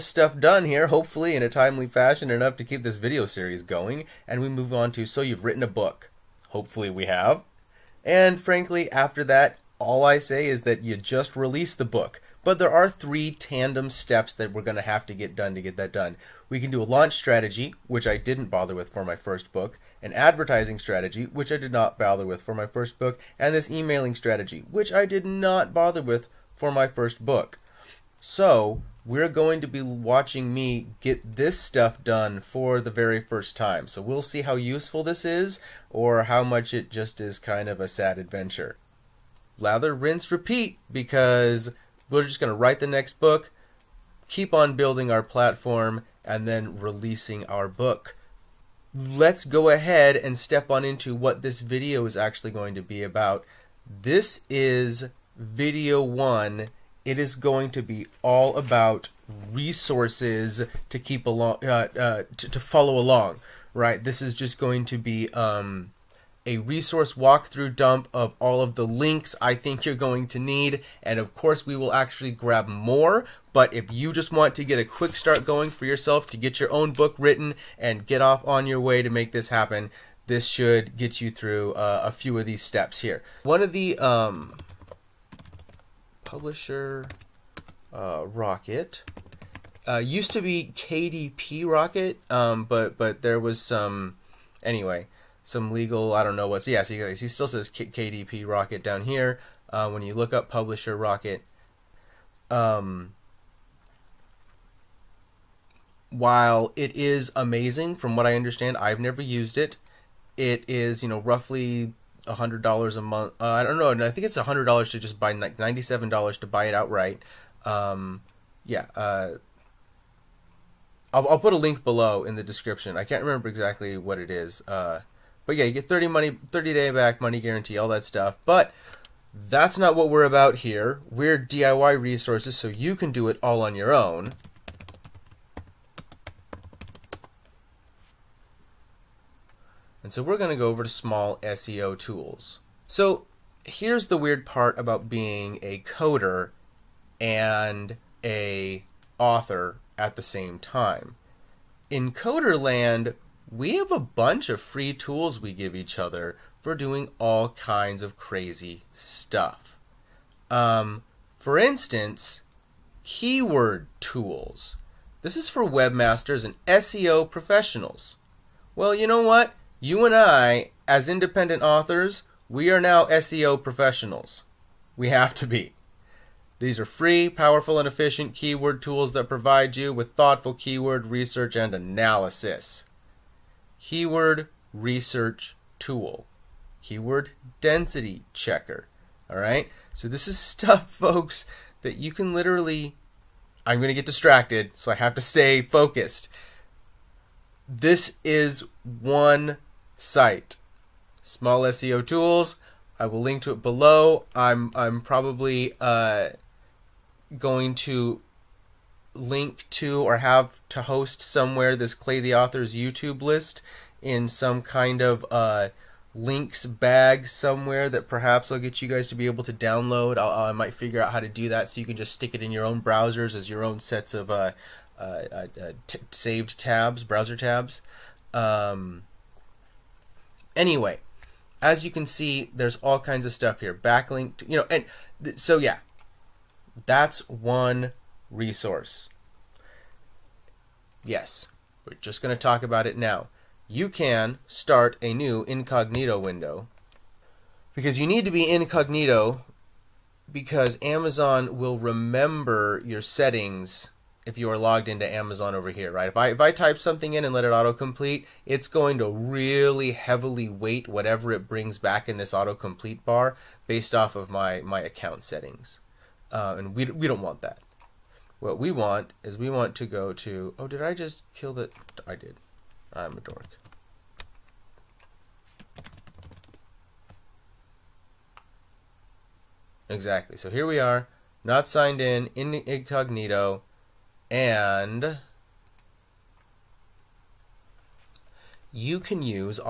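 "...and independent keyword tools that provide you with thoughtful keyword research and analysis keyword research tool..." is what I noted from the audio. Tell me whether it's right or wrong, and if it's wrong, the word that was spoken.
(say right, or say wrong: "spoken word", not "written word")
wrong: "efficient", not "independent".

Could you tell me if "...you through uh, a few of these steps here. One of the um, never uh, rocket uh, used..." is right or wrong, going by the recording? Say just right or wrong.
wrong.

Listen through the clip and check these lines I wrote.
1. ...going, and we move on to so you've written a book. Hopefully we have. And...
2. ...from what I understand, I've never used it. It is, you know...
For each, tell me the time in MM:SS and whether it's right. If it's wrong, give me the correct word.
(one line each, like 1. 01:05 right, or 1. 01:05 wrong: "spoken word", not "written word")
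1. 00:03 right
2. 01:47 right.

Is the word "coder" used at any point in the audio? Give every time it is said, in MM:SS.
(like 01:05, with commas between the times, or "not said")
02:25, 02:32.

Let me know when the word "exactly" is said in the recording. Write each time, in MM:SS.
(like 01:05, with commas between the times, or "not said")
02:03, 04:39.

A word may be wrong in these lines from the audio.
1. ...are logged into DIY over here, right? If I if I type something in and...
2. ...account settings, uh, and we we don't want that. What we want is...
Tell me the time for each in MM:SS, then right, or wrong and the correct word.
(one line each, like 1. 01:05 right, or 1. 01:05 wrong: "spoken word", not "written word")
1. 04:14 wrong: "Amazon", not "DIY"
2. 04:24 right.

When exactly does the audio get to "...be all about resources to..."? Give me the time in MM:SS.
00:57.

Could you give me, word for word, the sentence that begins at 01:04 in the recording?
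This is just going to be um, a resource walkthrough dump of all of the links I think you're going to need.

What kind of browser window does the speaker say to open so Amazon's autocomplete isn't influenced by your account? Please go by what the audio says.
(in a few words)
Incognito window.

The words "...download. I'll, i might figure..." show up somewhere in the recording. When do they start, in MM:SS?
03:39.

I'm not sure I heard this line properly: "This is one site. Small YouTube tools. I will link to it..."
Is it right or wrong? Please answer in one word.
wrong.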